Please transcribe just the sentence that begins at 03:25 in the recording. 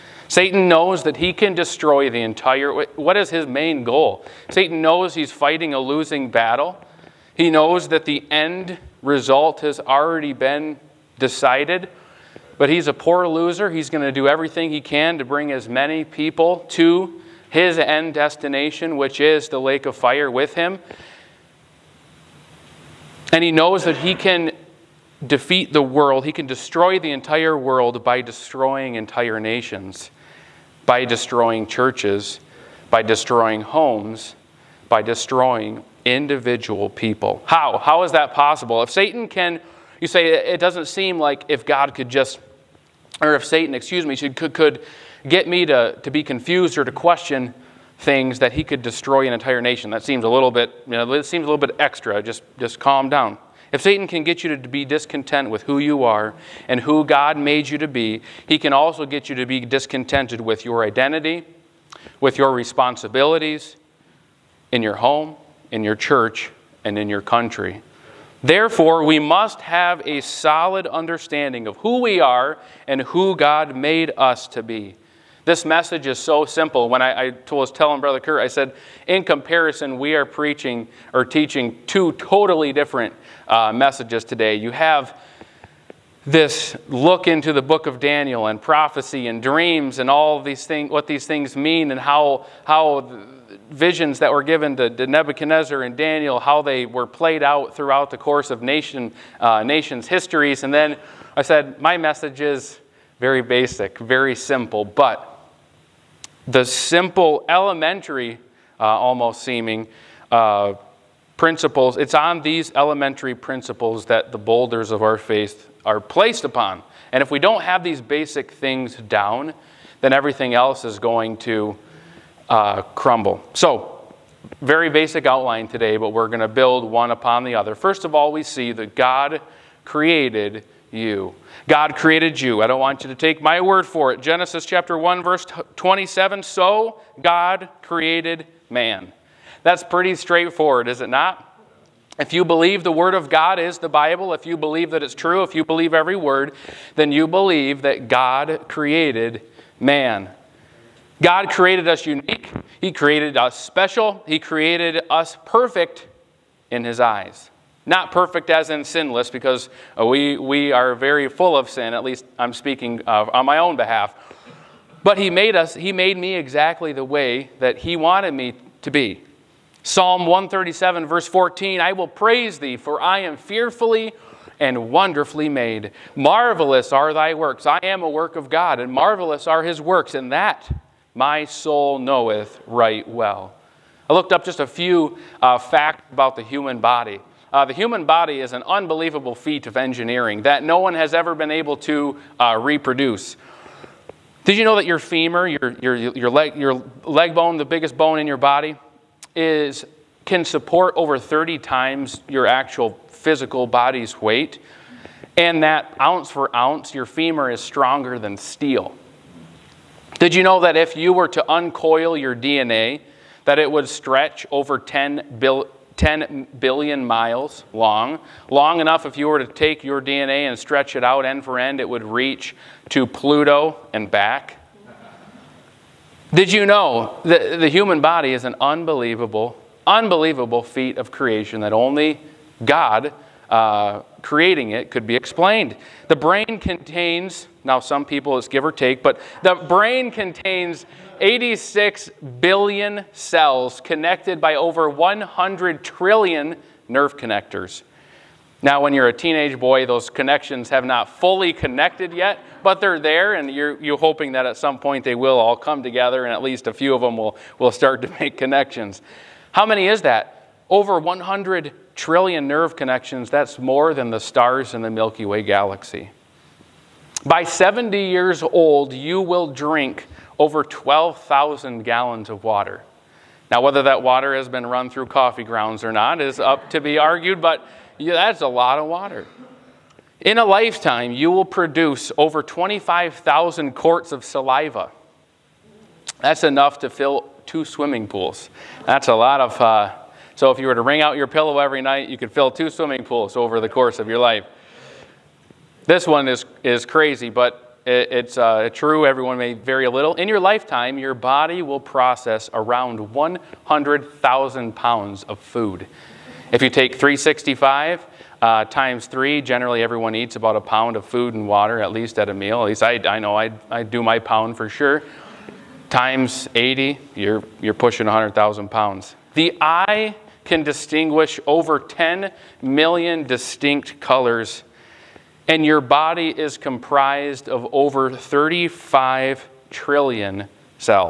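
And that ounce for ounce, your femur is stronger than steel.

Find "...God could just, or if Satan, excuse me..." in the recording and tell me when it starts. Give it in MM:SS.
00:41.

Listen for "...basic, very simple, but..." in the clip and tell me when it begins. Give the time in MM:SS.
01:43.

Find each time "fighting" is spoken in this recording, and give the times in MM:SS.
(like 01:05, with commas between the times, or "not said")
00:05.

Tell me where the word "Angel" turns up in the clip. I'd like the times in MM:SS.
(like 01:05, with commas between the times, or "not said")
not said.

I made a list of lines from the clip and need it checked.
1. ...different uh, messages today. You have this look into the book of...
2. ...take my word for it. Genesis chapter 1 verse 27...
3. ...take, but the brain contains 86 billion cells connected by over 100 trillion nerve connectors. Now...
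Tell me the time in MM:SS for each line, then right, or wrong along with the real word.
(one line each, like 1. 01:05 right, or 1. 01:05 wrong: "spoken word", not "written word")
1. 01:22 right
2. 02:13 right
3. 03:58 right.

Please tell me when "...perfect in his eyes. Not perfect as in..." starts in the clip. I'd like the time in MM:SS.
02:35.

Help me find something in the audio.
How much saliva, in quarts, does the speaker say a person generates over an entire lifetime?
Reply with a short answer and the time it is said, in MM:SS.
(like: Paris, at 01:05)
25,000 quarts, at 04:42.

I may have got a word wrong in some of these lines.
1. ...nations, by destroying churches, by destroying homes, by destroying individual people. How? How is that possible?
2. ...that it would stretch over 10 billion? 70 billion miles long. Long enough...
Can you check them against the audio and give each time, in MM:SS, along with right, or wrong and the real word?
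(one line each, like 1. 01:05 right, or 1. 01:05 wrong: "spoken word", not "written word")
1. 00:29 right
2. 03:33 wrong: "10", not "70".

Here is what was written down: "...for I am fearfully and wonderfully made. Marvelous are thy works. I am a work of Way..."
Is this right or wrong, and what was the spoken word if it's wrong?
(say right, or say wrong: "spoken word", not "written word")
wrong: "God", not "Way".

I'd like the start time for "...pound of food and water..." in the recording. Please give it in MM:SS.
05:10.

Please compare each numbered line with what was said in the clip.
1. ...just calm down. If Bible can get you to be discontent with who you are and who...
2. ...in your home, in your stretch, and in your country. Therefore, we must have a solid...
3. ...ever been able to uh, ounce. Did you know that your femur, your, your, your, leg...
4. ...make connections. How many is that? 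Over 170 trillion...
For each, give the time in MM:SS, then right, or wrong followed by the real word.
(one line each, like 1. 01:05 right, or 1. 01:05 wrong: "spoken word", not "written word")
1. 00:52 wrong: "Satan", not "Bible"
2. 01:04 wrong: "church", not "stretch"
3. 03:11 wrong: "reproduce", not "ounce"
4. 04:18 wrong: "100", not "170".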